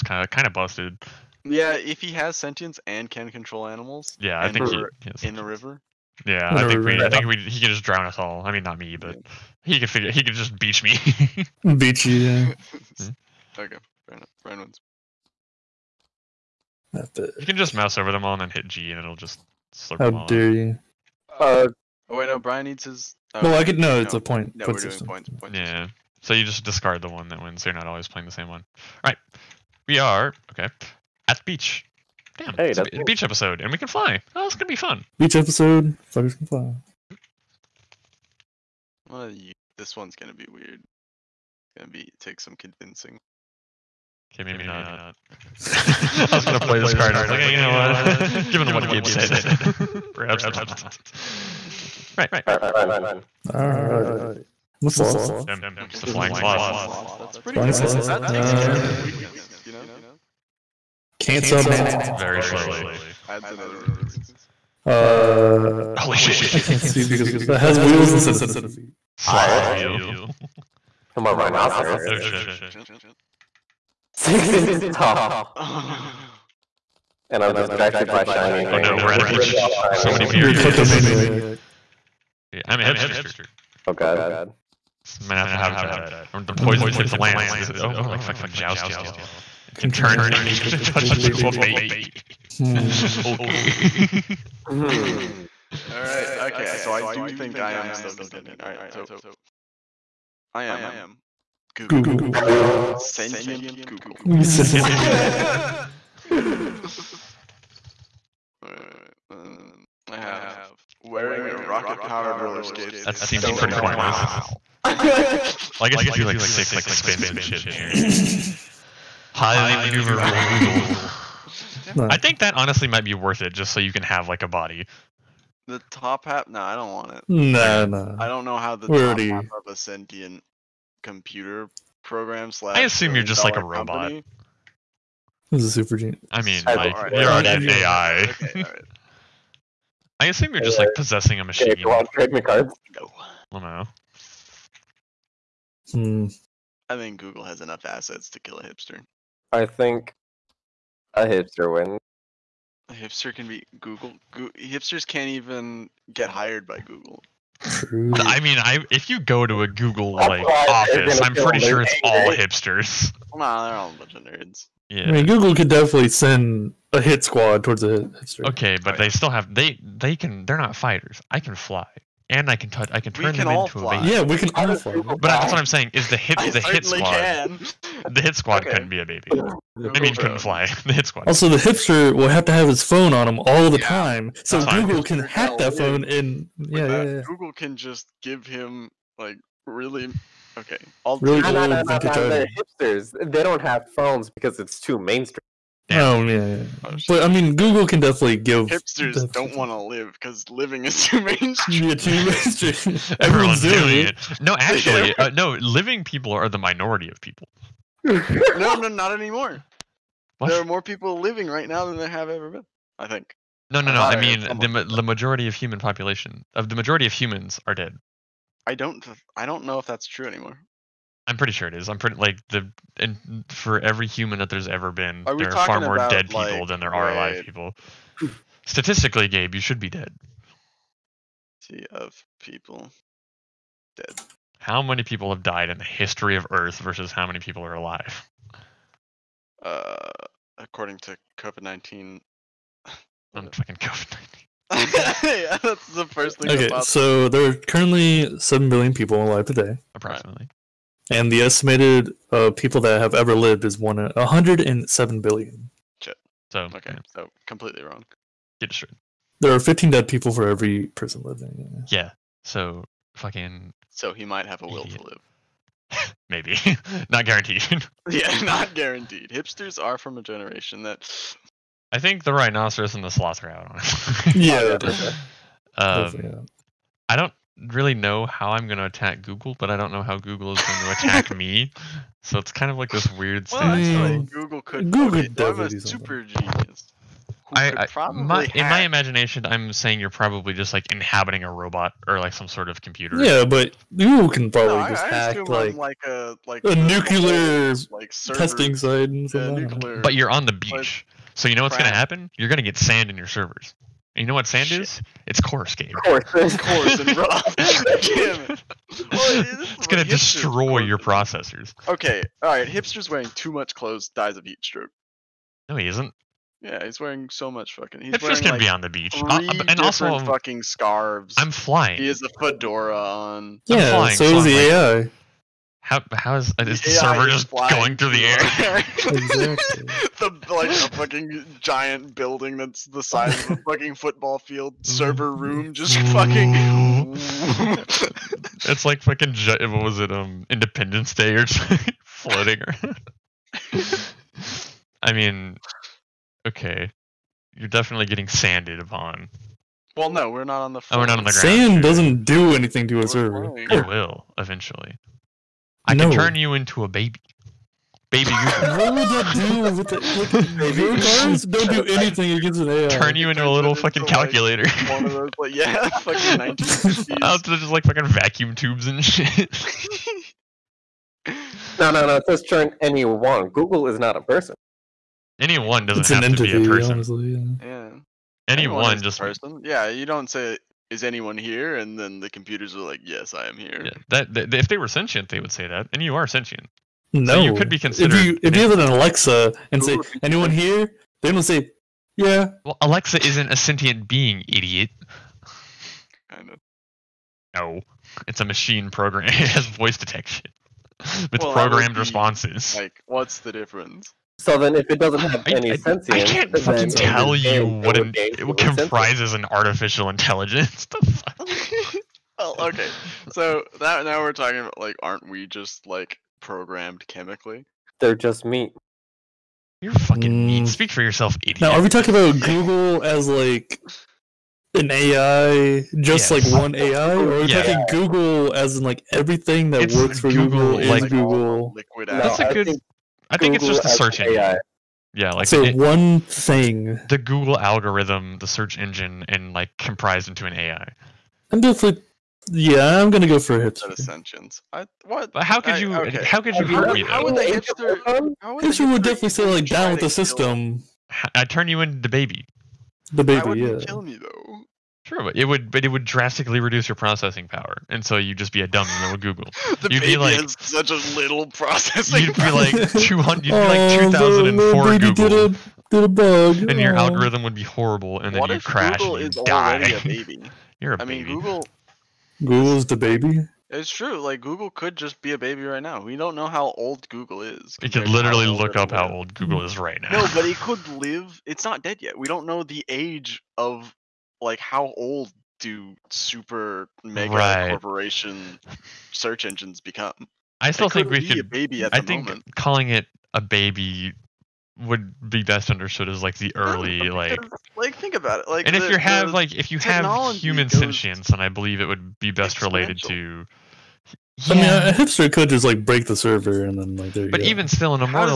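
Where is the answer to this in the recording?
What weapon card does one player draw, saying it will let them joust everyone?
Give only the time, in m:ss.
1:26.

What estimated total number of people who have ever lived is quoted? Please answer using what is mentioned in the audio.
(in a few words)
107 billion.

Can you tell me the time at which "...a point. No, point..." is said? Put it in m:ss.
0:24.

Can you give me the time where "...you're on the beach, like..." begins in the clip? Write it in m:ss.
5:00.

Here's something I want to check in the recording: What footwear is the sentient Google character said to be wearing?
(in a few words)
rocket-powered roller skates.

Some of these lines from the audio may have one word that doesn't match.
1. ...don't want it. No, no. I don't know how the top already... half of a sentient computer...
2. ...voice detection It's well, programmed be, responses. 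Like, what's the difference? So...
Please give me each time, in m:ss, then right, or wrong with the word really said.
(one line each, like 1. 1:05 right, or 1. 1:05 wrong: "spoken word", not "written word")
1. 2:06 right
2. 6:39 right.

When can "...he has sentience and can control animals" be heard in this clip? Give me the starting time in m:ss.
0:02.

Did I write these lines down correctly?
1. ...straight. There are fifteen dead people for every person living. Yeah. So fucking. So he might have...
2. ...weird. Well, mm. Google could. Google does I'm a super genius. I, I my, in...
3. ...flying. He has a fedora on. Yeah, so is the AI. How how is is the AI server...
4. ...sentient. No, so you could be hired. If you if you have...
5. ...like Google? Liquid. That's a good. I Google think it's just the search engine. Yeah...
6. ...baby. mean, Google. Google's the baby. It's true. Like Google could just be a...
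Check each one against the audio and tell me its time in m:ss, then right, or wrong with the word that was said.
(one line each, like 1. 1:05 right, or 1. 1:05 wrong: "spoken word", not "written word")
1. 4:18 right
2. 4:43 right
3. 5:21 right
4. 6:26 wrong: "considered", not "hired"
5. 7:10 right
6. 7:51 right.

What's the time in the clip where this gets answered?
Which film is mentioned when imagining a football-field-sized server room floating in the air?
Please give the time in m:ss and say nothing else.
5:40.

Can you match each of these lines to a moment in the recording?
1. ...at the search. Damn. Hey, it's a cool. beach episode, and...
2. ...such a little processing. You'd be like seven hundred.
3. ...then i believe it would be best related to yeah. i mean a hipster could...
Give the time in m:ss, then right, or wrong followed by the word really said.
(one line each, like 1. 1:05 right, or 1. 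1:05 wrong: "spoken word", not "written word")
1. 0:31 wrong: "beach", not "search"
2. 7:40 wrong: "two", not "seven"
3. 8:21 right.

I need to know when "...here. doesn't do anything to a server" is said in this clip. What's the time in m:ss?
5:51.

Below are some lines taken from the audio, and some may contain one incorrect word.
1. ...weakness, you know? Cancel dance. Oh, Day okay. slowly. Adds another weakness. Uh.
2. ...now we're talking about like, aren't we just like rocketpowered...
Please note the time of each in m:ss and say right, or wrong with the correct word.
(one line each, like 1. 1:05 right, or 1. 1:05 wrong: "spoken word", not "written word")
1. 0:59 wrong: "Very", not "Day"
2. 6:54 wrong: "programmed", not "rocketpowered".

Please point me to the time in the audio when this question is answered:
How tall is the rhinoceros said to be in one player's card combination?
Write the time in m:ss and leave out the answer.
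1:14.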